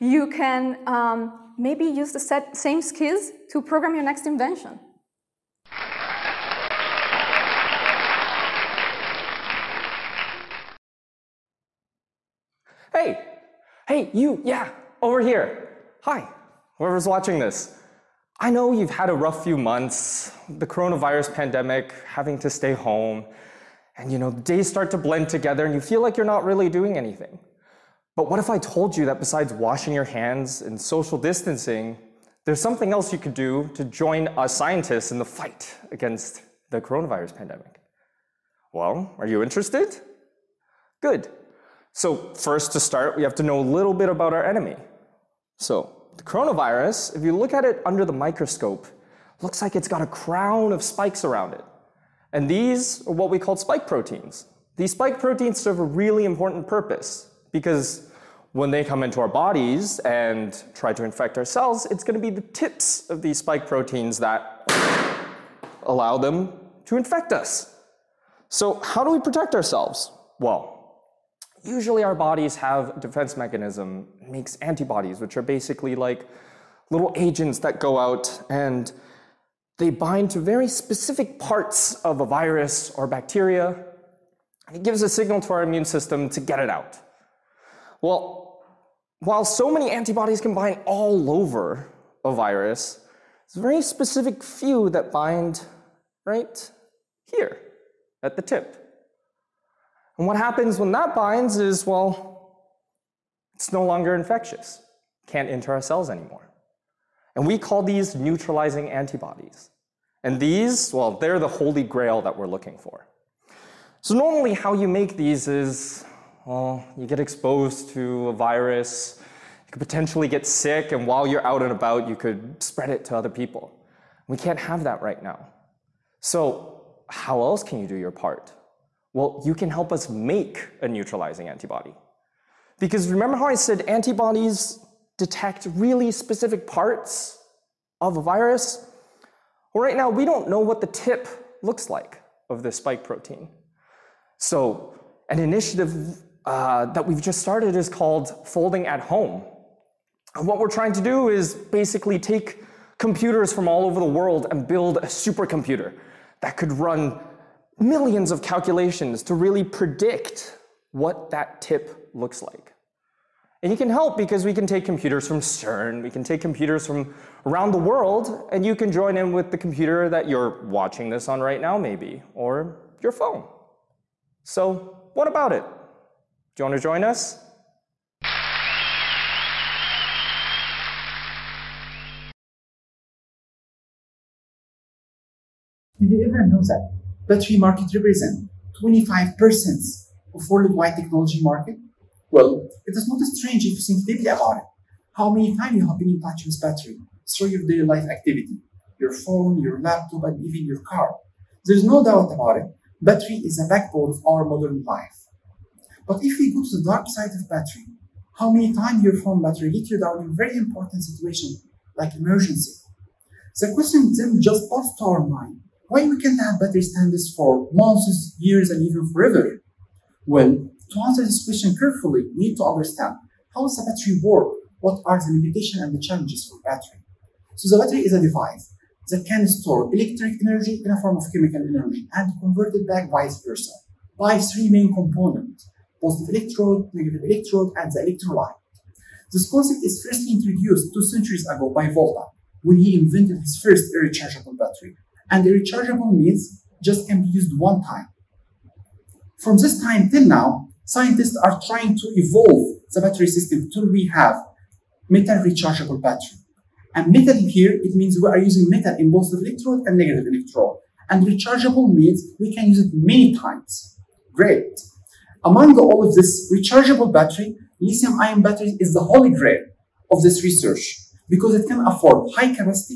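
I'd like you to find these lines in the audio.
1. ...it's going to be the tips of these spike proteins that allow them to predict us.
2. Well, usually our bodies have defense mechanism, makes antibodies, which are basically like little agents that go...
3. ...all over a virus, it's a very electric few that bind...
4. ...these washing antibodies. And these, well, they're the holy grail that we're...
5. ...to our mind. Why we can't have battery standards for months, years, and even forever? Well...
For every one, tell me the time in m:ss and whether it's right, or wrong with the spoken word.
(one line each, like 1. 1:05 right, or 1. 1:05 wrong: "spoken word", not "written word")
1. 1:01 wrong: "infect", not "predict"
2. 1:10 right
3. 1:30 wrong: "specific", not "electric"
4. 1:47 wrong: "neutralizing", not "washing"
5. 3:34 right.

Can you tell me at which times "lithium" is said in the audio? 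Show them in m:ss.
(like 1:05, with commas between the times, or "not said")
4:27.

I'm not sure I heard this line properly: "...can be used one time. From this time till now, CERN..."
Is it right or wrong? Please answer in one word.
wrong.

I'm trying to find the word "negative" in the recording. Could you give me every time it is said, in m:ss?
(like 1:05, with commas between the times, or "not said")
3:56, 4:19.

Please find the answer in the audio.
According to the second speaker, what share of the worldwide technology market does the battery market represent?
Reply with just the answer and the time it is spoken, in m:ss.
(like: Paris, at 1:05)
25%, at 3:08.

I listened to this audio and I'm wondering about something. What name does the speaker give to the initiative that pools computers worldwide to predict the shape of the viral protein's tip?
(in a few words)
Folding at Home.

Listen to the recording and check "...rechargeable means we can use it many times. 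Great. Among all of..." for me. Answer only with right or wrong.
right.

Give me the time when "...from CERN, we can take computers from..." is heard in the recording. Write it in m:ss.
2:45.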